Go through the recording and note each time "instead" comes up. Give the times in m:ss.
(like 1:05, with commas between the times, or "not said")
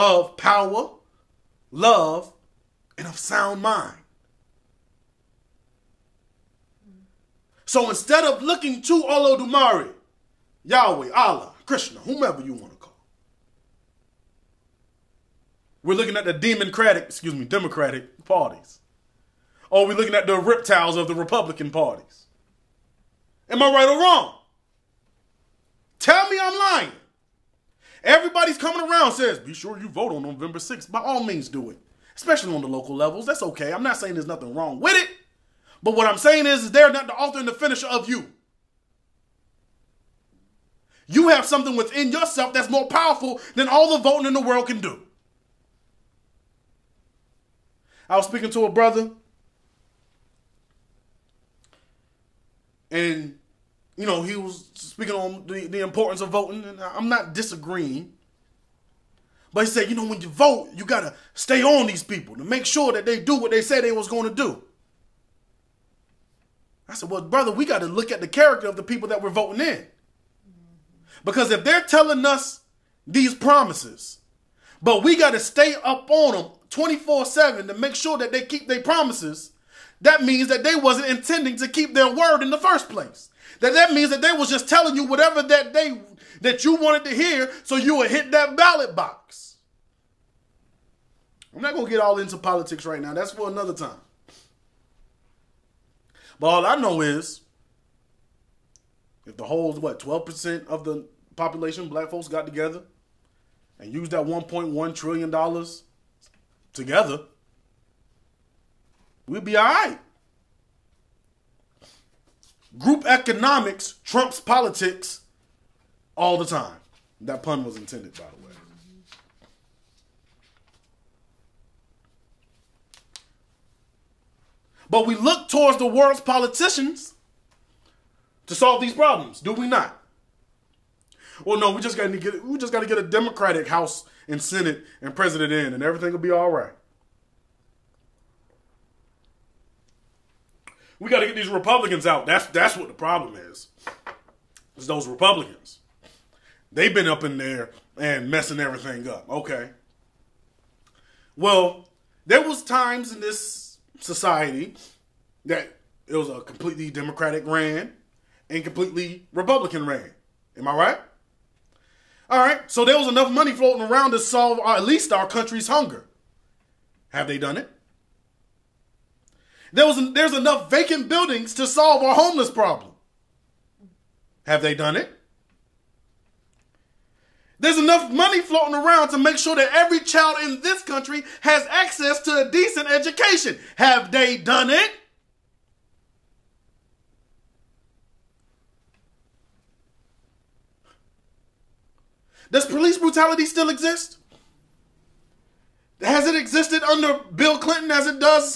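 0:07.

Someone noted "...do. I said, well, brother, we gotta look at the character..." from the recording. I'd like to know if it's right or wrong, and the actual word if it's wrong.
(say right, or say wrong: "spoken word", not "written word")
right.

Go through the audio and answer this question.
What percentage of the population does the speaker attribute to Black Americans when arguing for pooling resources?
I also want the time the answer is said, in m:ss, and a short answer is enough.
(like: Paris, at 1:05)
12%, at 1:39.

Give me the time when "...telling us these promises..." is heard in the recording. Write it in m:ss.
1:11.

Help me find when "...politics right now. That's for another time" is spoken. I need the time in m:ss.
1:32.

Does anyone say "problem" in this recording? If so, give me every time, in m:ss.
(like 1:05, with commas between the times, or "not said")
2:08, 2:22, 2:52.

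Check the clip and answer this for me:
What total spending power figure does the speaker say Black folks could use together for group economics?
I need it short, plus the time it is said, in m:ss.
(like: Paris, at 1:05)
$1.1 trillion, at 1:44.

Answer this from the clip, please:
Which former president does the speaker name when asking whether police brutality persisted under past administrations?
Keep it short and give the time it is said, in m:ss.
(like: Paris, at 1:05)
Bill Clinton, at 3:17.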